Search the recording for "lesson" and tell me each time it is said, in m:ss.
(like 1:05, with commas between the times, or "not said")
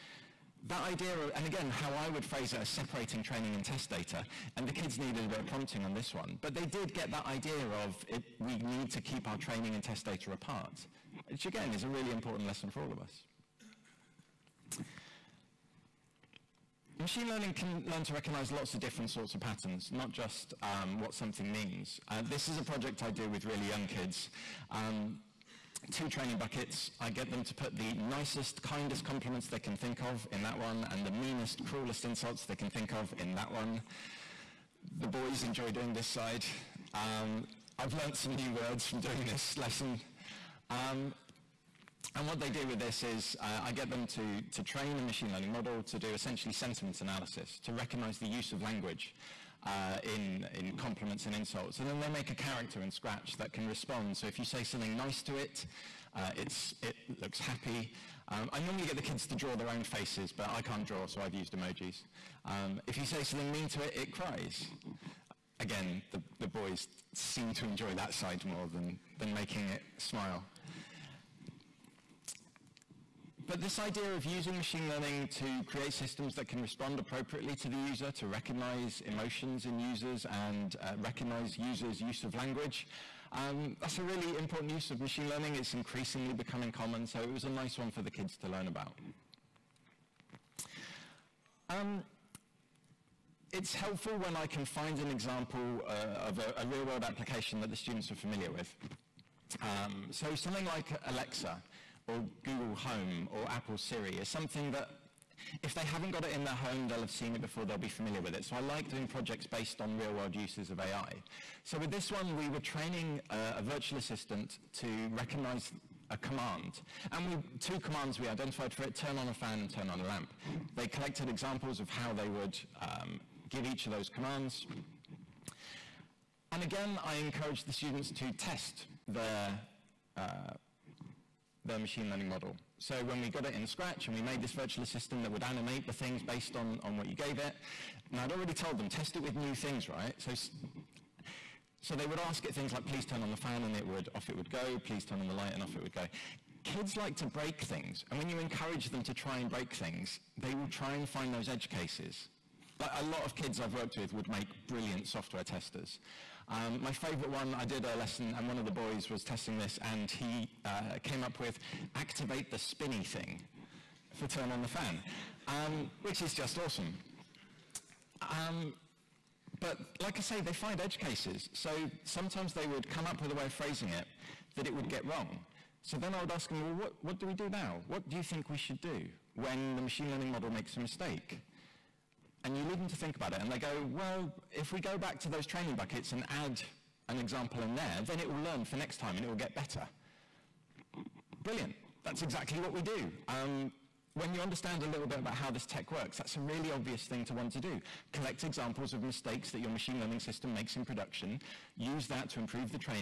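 0:12, 0:39, 2:37.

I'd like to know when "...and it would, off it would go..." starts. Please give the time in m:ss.
2:23.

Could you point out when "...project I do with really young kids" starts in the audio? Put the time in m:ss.
0:22.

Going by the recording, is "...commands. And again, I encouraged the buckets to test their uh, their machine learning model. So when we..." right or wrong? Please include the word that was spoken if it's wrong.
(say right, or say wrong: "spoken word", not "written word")
wrong: "students", not "buckets".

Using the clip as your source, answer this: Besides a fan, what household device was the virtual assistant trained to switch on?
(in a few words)
A lamp.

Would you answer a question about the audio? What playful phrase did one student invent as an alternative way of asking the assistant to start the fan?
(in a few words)
Activate the spinny thing.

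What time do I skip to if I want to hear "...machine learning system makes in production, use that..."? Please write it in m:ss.
3:19.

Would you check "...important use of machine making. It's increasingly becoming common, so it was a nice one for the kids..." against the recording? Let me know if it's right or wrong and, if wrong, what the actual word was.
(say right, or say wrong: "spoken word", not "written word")
wrong: "learning", not "making".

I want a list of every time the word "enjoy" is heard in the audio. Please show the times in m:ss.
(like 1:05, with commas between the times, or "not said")
0:35, 1:07.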